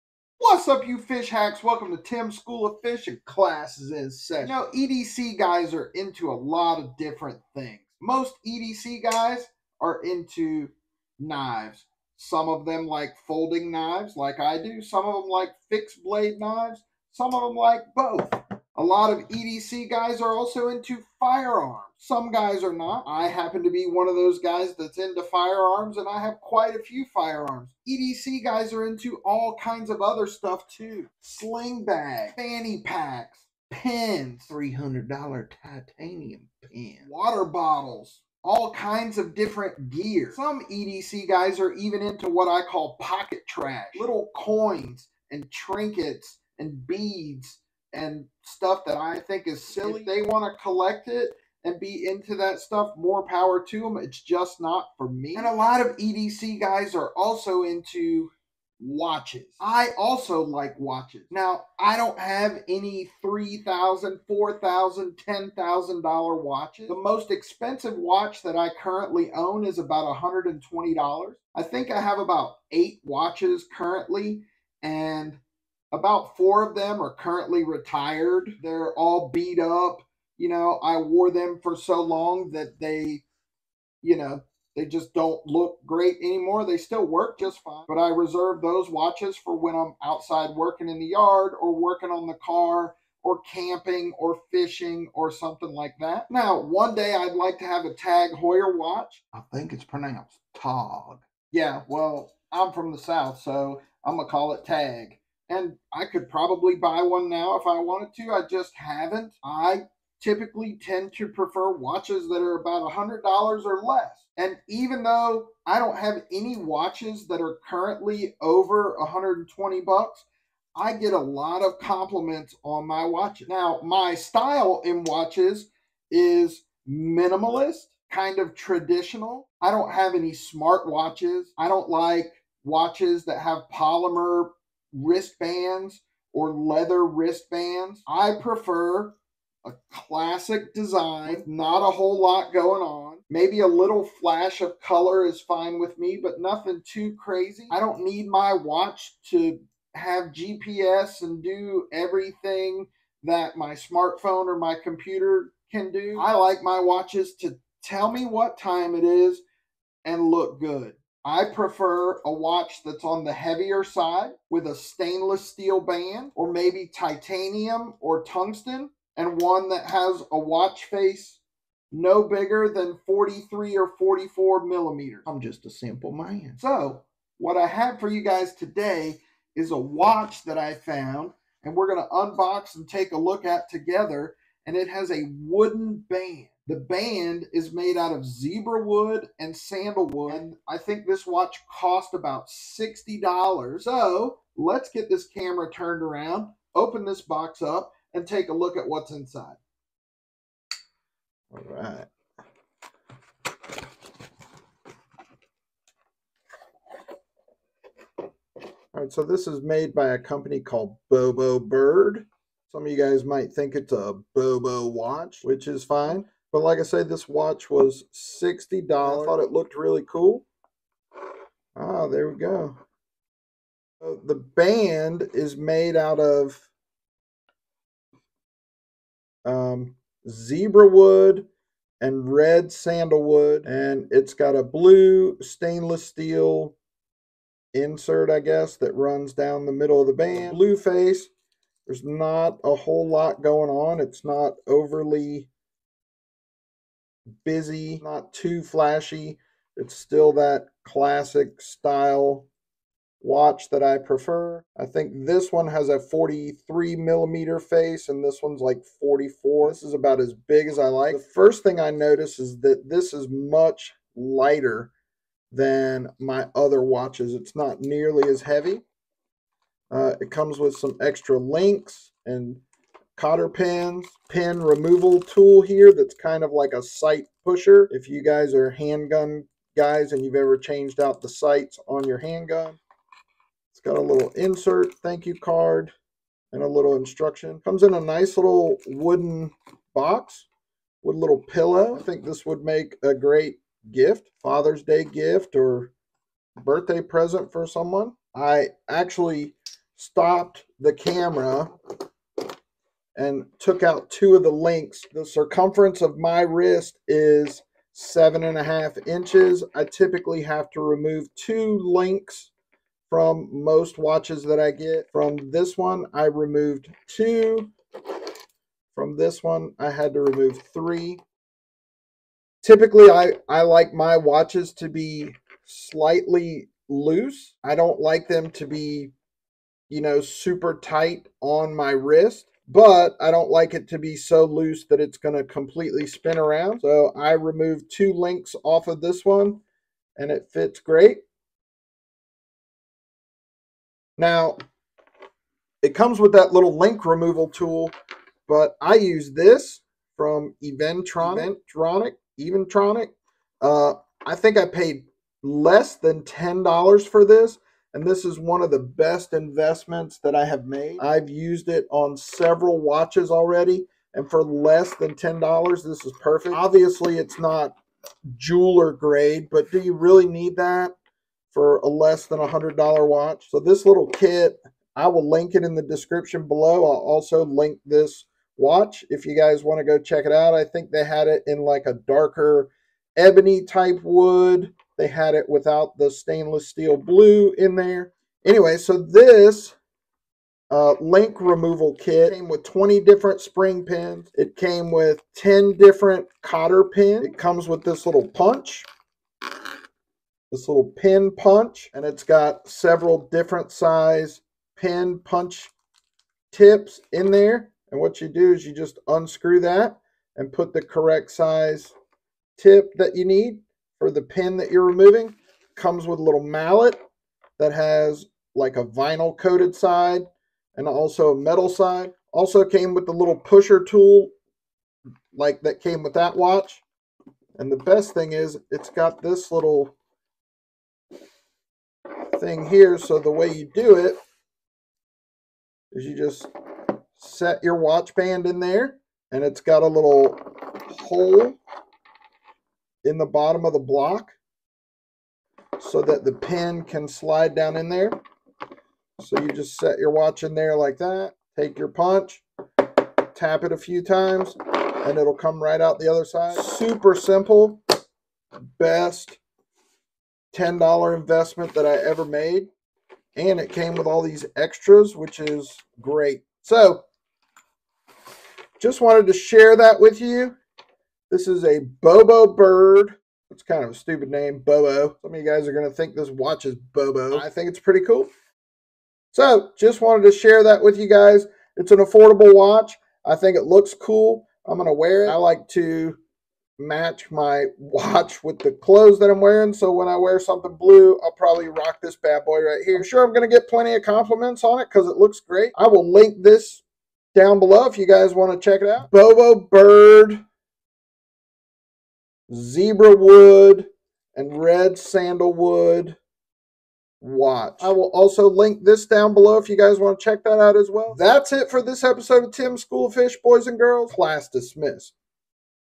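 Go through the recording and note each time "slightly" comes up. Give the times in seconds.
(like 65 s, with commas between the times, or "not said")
325 s.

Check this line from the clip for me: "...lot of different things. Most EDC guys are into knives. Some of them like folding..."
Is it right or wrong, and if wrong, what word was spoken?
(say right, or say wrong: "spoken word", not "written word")
right.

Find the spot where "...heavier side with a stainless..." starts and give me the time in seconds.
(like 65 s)
163 s.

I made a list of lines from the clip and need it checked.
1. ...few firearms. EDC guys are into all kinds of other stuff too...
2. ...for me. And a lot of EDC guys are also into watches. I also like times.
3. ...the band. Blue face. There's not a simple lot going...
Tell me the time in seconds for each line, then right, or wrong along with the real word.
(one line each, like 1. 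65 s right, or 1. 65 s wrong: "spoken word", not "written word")
1. 26 s right
2. 54 s wrong: "watches", not "times"
3. 240 s wrong: "whole", not "simple".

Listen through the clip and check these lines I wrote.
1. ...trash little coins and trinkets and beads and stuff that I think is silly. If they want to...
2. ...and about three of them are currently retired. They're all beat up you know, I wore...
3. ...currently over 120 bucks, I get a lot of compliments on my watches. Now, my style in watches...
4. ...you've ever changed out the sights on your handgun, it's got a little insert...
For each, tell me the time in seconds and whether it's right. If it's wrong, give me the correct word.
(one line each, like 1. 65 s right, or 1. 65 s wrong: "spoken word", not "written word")
1. 43 s right
2. 74 s wrong: "four", not "three"
3. 117 s right
4. 280 s right.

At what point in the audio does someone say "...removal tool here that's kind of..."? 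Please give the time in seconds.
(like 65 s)
274 s.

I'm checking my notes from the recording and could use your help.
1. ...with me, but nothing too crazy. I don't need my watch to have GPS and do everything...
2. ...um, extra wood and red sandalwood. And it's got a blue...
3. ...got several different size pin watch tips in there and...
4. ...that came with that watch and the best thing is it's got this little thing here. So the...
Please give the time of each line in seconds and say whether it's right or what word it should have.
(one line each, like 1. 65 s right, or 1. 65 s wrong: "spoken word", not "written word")
1. 145 s right
2. 229 s wrong: "zebra", not "extra"
3. 402 s wrong: "punch", not "watch"
4. 425 s right.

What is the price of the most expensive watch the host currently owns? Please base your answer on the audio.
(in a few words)
$120.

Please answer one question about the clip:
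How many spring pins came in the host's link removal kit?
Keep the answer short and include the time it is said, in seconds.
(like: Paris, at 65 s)
20, at 392 s.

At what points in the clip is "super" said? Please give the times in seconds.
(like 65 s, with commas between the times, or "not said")
330 s, 456 s.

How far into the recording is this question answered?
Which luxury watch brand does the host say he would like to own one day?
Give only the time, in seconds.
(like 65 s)
97 s.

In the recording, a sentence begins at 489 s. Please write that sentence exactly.
So when I wear something blue, I'll probably rock this bad boy right here.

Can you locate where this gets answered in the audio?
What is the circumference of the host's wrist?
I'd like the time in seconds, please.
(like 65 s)
307 s.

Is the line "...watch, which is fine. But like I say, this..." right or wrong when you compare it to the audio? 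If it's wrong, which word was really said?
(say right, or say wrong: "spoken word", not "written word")
right.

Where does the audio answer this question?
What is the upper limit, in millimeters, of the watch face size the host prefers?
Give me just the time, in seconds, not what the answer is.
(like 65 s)
173 s.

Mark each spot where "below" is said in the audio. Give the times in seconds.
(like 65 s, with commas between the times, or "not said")
376 s, 497 s, 509 s.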